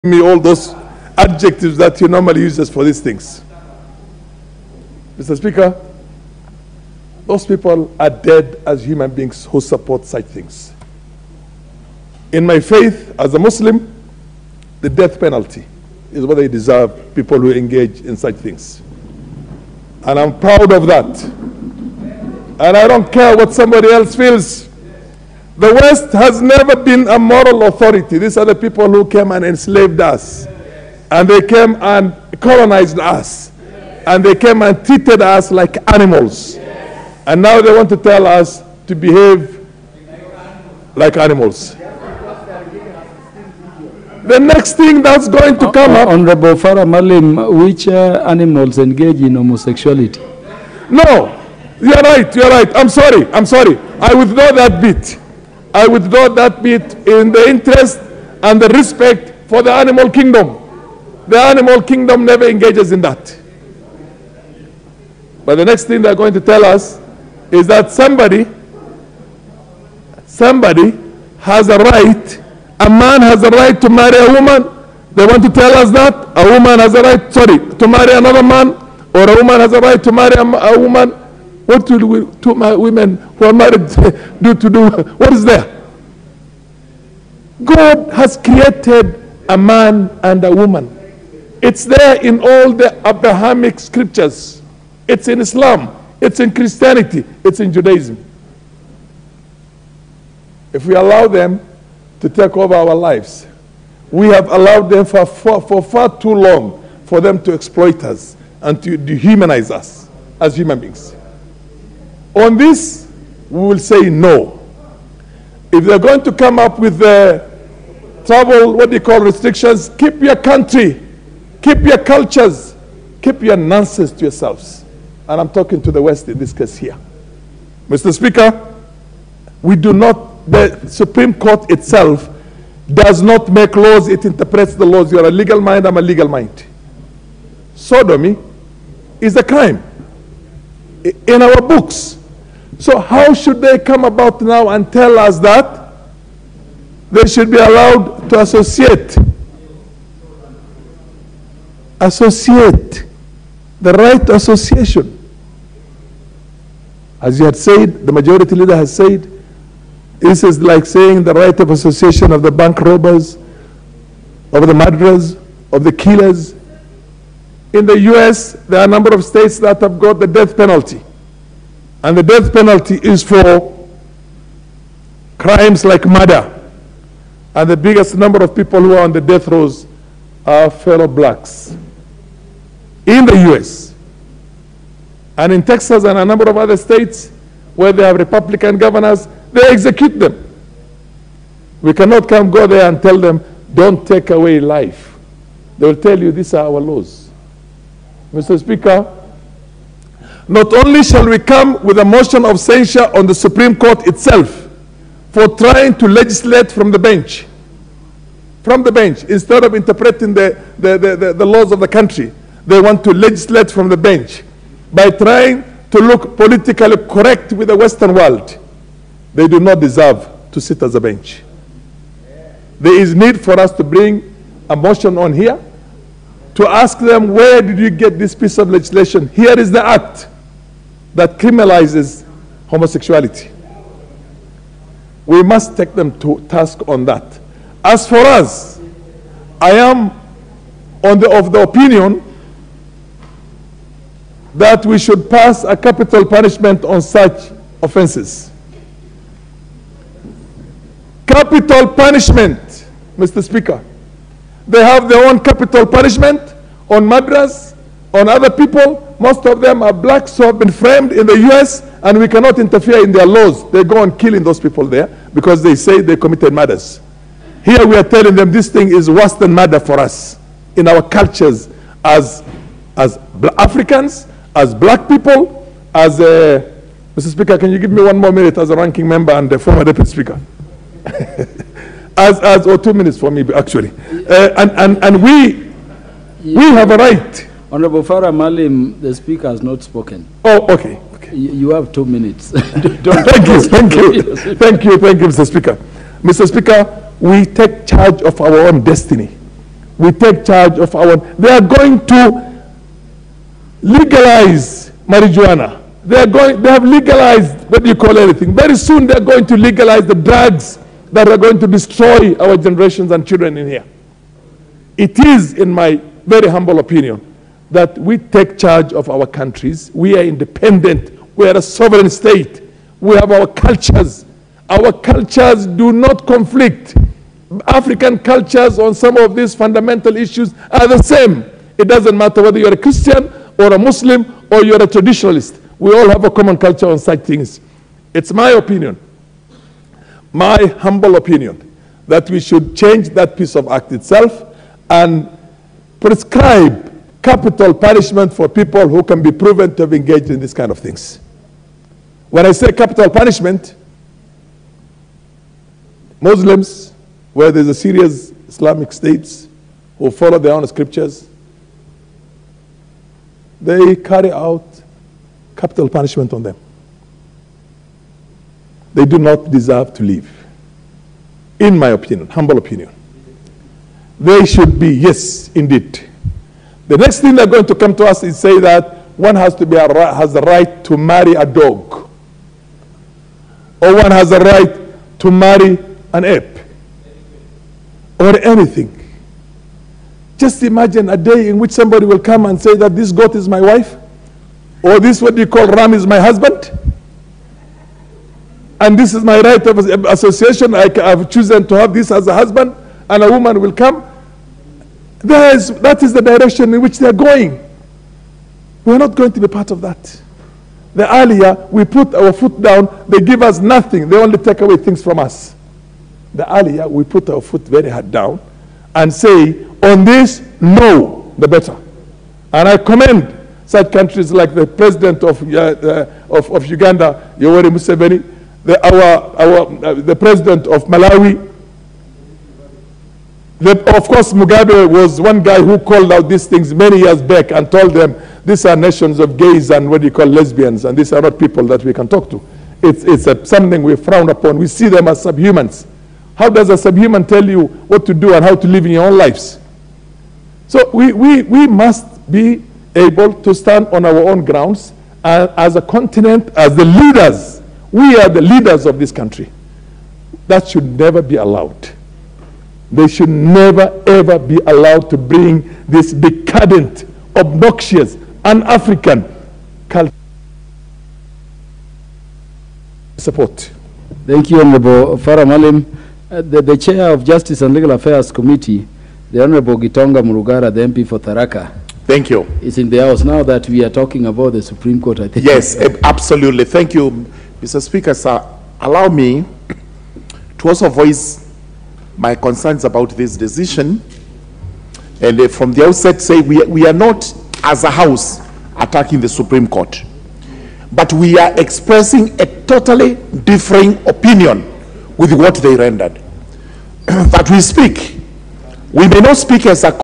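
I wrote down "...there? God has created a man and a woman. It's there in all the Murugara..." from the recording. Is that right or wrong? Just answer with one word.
wrong.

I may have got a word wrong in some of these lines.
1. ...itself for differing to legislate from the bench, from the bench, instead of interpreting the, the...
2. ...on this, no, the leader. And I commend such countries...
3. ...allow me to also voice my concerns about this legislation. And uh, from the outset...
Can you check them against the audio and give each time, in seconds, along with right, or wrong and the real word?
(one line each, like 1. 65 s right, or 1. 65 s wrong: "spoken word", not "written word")
1. 204 s wrong: "trying", not "differing"
2. 419 s wrong: "better", not "leader"
3. 488 s wrong: "decision", not "legislation".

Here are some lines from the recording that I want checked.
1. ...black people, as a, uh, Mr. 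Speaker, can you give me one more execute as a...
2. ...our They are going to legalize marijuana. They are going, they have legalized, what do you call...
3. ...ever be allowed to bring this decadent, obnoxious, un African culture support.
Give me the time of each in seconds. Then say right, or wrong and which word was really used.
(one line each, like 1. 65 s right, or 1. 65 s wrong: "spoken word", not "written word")
1. 274 s wrong: "minute", not "execute"
2. 300 s right
3. 464 s right.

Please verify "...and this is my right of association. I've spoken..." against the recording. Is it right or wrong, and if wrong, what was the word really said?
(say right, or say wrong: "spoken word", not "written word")
wrong: "chosen", not "spoken".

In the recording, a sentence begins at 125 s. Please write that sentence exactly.
And I'm talking to the West in this case here.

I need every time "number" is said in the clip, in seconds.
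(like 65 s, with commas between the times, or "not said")
168 s, 178 s, 186 s.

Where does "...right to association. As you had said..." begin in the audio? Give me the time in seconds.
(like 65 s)
153 s.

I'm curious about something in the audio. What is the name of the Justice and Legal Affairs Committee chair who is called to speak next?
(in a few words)
Gitonga Murugara.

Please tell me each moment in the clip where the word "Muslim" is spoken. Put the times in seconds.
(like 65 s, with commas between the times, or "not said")
13 s, 333 s, 356 s.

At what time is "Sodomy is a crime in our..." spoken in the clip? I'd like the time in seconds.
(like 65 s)
137 s.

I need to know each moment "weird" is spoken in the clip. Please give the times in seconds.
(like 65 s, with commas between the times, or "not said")
not said.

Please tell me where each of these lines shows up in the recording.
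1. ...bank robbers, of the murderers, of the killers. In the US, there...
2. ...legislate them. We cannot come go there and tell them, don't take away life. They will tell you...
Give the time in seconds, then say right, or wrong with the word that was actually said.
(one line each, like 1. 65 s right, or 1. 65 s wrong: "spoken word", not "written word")
1. 162 s right
2. 189 s wrong: "execute", not "legislate".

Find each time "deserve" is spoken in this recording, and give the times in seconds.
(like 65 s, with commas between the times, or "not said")
16 s, 219 s, 369 s.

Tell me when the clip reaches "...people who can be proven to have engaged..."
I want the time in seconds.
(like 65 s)
348 s.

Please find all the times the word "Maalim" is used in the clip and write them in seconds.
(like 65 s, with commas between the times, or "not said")
46 s, 288 s, 475 s.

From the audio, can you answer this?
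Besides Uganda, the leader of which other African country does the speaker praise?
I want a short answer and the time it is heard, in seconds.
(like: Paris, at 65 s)
Malawi, at 430 s.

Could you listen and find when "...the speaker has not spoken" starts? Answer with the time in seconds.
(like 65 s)
288 s.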